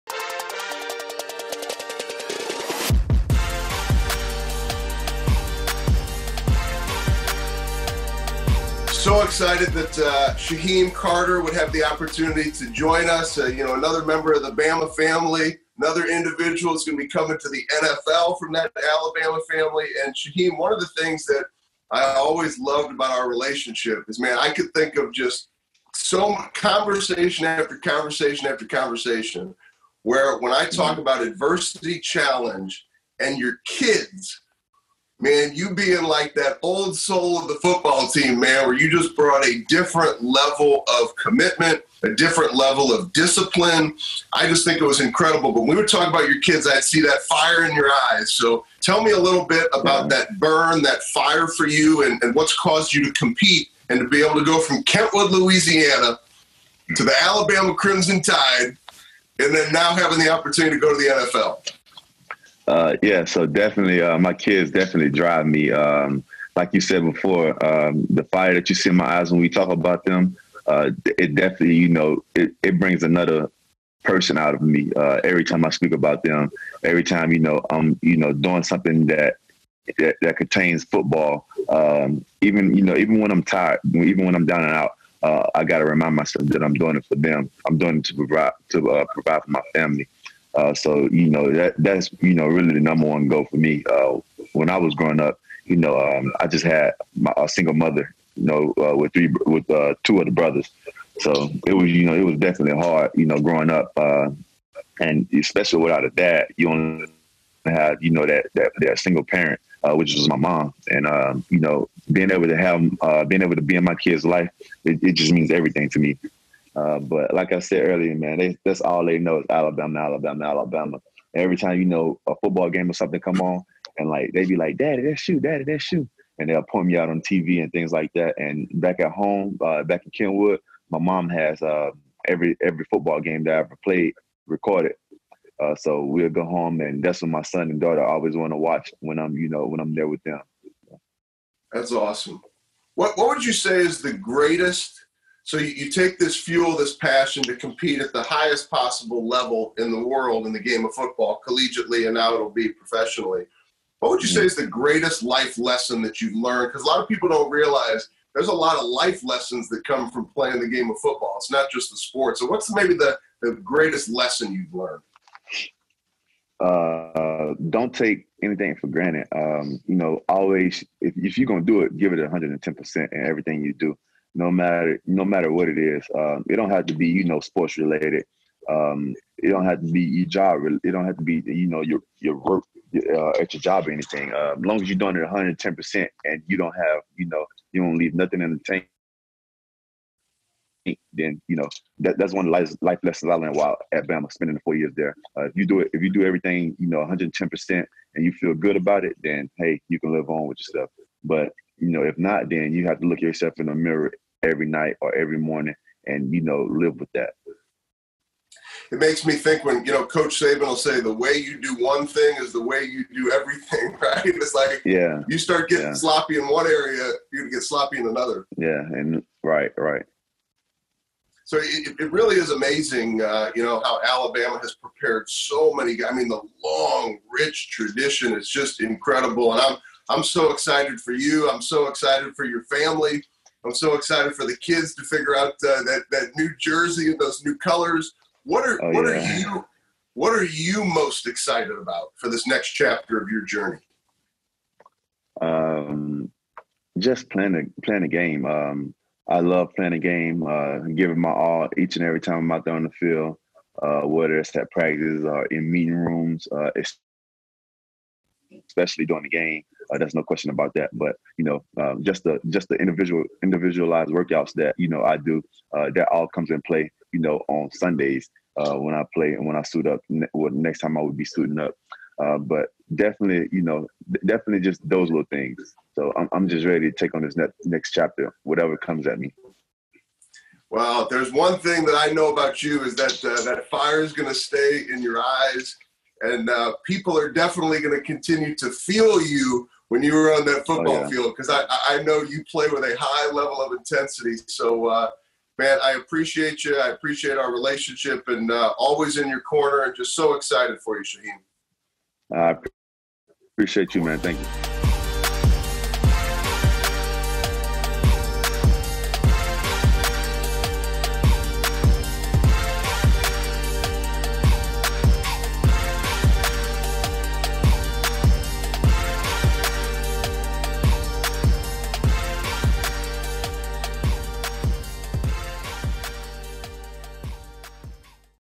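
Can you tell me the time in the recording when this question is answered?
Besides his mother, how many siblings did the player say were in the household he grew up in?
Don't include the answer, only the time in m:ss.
1:40.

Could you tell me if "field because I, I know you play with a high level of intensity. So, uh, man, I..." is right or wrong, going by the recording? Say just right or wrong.
right.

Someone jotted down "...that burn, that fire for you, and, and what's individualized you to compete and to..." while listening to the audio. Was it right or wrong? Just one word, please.
wrong.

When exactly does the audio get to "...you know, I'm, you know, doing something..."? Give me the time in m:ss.
1:17.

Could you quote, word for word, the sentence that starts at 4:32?
Uh, but definitely, you know, definitely just those little things.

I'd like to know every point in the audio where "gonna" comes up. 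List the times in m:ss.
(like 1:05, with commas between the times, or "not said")
2:51.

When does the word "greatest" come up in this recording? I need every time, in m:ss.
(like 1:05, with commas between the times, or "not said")
2:24, 2:34, 2:43.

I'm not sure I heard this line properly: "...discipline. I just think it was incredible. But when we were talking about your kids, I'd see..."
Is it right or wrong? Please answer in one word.
right.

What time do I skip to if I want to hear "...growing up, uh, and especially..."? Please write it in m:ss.
1:43.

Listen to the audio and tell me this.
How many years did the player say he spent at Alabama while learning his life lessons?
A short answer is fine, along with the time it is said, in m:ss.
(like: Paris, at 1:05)
4, at 3:14.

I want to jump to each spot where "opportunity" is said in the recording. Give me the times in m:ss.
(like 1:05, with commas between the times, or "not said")
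0:11, 1:00.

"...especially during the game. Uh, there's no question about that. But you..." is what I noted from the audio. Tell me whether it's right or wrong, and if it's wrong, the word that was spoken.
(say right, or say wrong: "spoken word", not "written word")
right.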